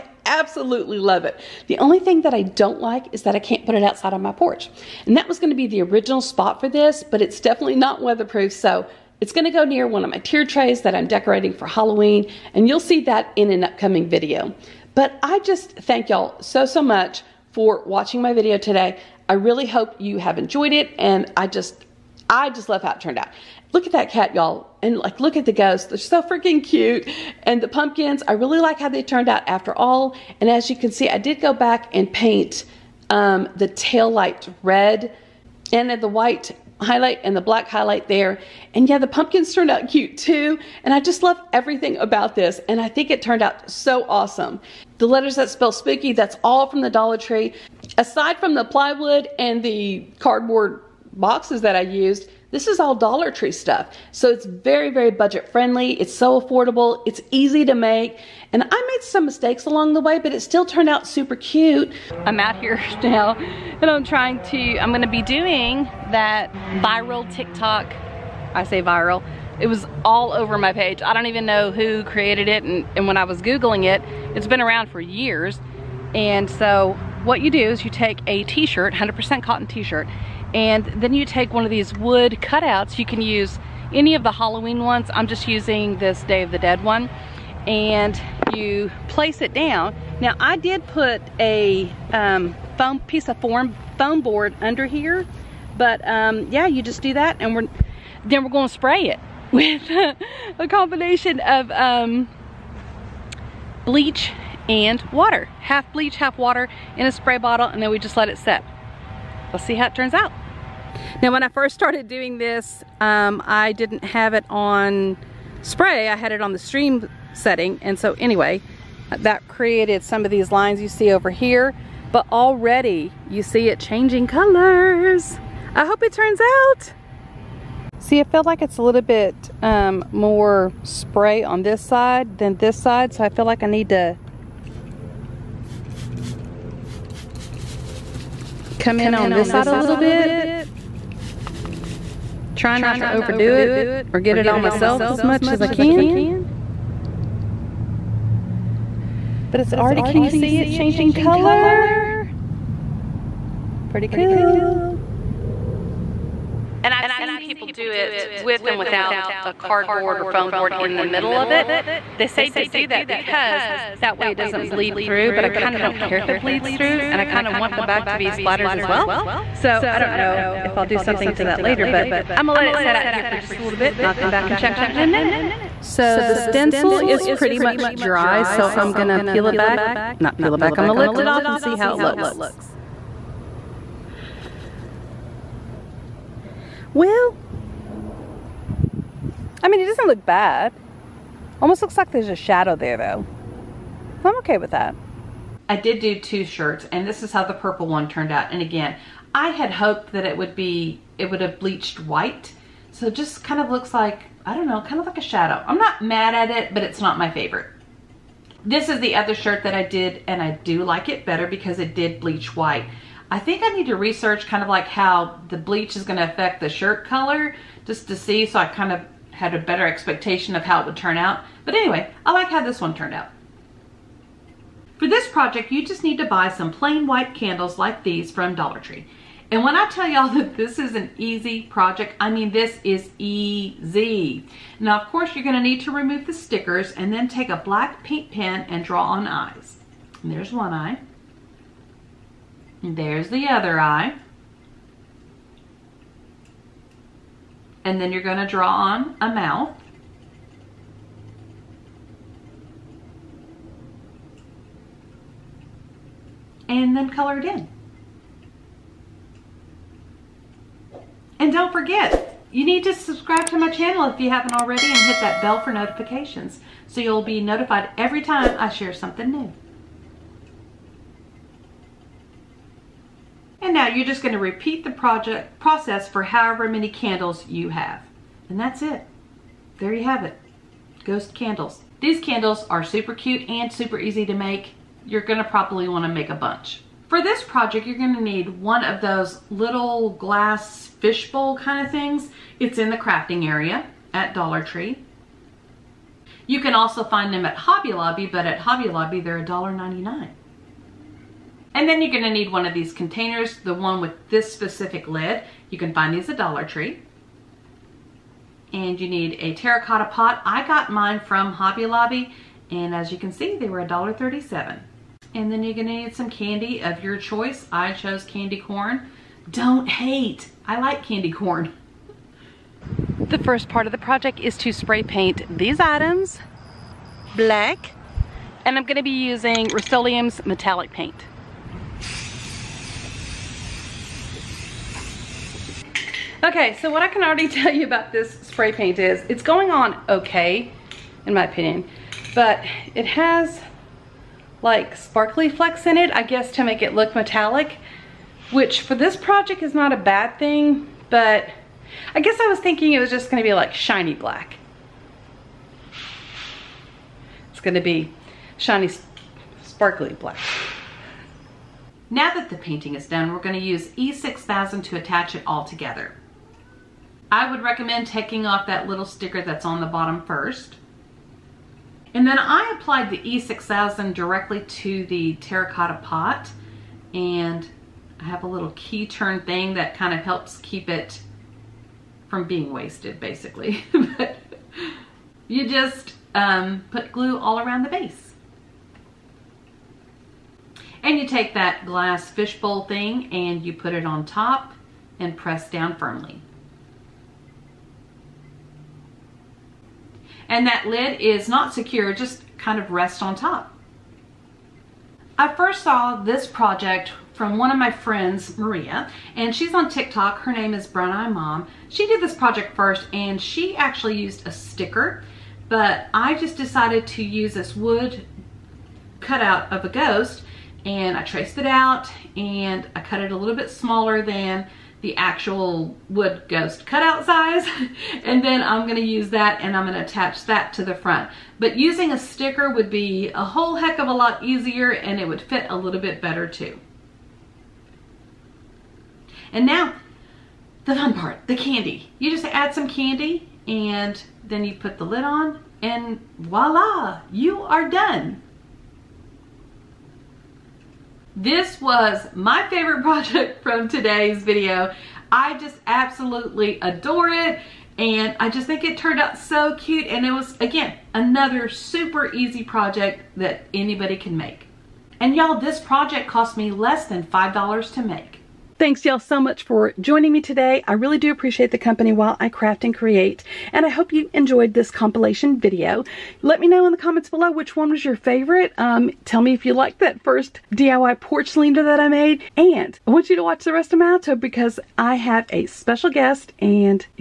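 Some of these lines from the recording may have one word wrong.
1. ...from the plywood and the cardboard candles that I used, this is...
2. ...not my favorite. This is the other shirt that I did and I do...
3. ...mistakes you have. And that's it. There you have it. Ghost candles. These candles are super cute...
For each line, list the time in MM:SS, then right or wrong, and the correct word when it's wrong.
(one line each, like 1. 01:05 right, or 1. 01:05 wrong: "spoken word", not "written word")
1. 00:48 wrong: "boxes", not "candles"
2. 03:26 right
3. 04:36 wrong: "candles", not "mistakes".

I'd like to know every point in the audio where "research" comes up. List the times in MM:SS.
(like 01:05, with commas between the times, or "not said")
03:33.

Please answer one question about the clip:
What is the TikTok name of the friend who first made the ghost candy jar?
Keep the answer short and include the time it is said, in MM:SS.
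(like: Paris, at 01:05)
Brown Eye Mom, at 06:50.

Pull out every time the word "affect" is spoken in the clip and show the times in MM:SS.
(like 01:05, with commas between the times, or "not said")
03:36.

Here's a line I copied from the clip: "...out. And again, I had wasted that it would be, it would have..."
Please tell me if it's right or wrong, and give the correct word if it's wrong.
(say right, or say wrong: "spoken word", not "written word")
wrong: "hoped", not "wasted".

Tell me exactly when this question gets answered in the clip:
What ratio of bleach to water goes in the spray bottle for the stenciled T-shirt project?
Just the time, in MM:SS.
01:45.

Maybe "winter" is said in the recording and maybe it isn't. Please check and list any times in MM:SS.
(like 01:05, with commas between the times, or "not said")
not said.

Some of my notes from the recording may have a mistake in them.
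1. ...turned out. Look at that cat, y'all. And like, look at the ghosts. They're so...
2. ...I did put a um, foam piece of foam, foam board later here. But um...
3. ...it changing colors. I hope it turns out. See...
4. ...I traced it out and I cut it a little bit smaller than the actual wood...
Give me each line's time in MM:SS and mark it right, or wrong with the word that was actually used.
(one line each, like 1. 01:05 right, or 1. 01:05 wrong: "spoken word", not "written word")
1. 00:22 right
2. 01:30 wrong: "under", not "later"
3. 02:03 right
4. 07:01 right.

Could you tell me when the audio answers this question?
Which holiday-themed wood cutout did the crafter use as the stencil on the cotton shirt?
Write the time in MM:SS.
01:26.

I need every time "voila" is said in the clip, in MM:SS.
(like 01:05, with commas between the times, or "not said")
07:26.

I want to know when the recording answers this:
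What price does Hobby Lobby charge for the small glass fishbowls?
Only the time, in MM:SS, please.
04:59.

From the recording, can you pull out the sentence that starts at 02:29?
But it's already, can you see it changing color?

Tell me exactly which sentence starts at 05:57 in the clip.
It's gonna be shiny, sparkly black.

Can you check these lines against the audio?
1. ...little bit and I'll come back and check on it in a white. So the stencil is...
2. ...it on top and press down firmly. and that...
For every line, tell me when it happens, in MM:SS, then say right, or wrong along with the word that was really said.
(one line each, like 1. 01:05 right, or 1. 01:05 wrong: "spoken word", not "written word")
1. 02:53 wrong: "minute", not "white"
2. 06:33 right.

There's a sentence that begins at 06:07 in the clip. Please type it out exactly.
I would recommend taking off that little sticker that's on the bottom first.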